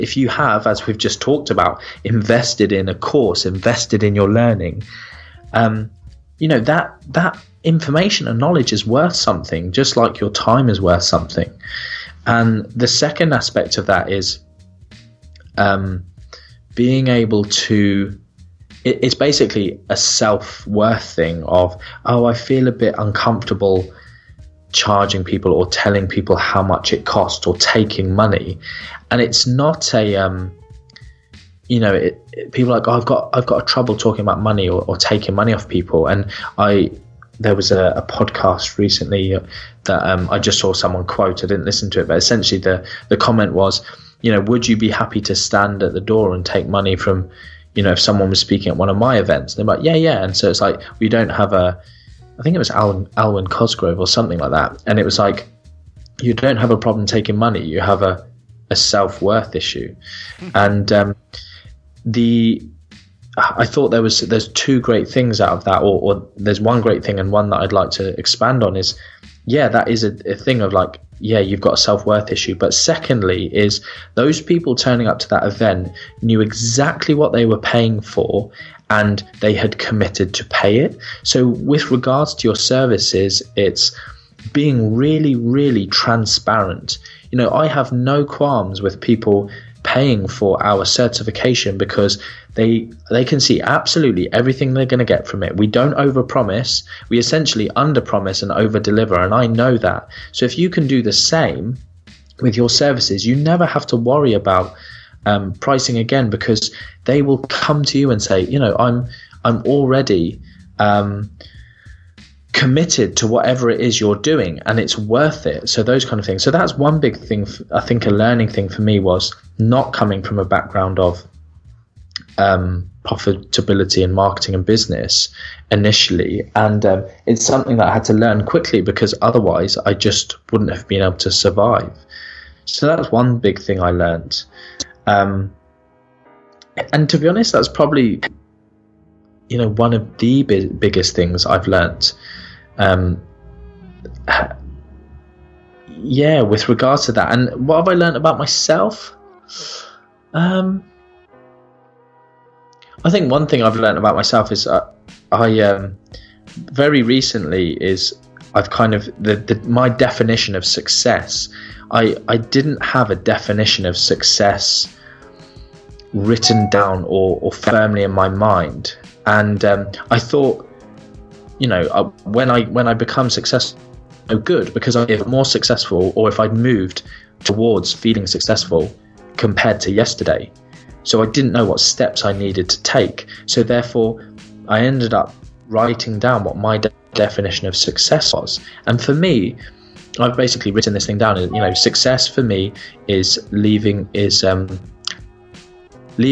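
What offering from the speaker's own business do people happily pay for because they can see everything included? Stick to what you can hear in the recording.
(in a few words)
certification.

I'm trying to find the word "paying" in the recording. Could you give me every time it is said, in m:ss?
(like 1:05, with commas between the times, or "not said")
1:17, 1:29.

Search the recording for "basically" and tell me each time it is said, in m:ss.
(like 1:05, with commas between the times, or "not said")
0:19, 3:10.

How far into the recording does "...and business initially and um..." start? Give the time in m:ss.
2:04.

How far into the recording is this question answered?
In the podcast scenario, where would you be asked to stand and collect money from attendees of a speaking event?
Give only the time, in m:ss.
0:45.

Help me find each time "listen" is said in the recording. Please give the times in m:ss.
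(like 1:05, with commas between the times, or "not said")
0:41.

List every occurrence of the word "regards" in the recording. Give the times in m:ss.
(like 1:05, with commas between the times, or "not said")
1:21, 2:26.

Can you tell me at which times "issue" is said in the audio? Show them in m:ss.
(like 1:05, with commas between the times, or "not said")
0:59, 1:12.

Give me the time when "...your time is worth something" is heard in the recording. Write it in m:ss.
0:10.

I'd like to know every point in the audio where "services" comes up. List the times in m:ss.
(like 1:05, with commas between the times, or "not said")
1:22, 1:42.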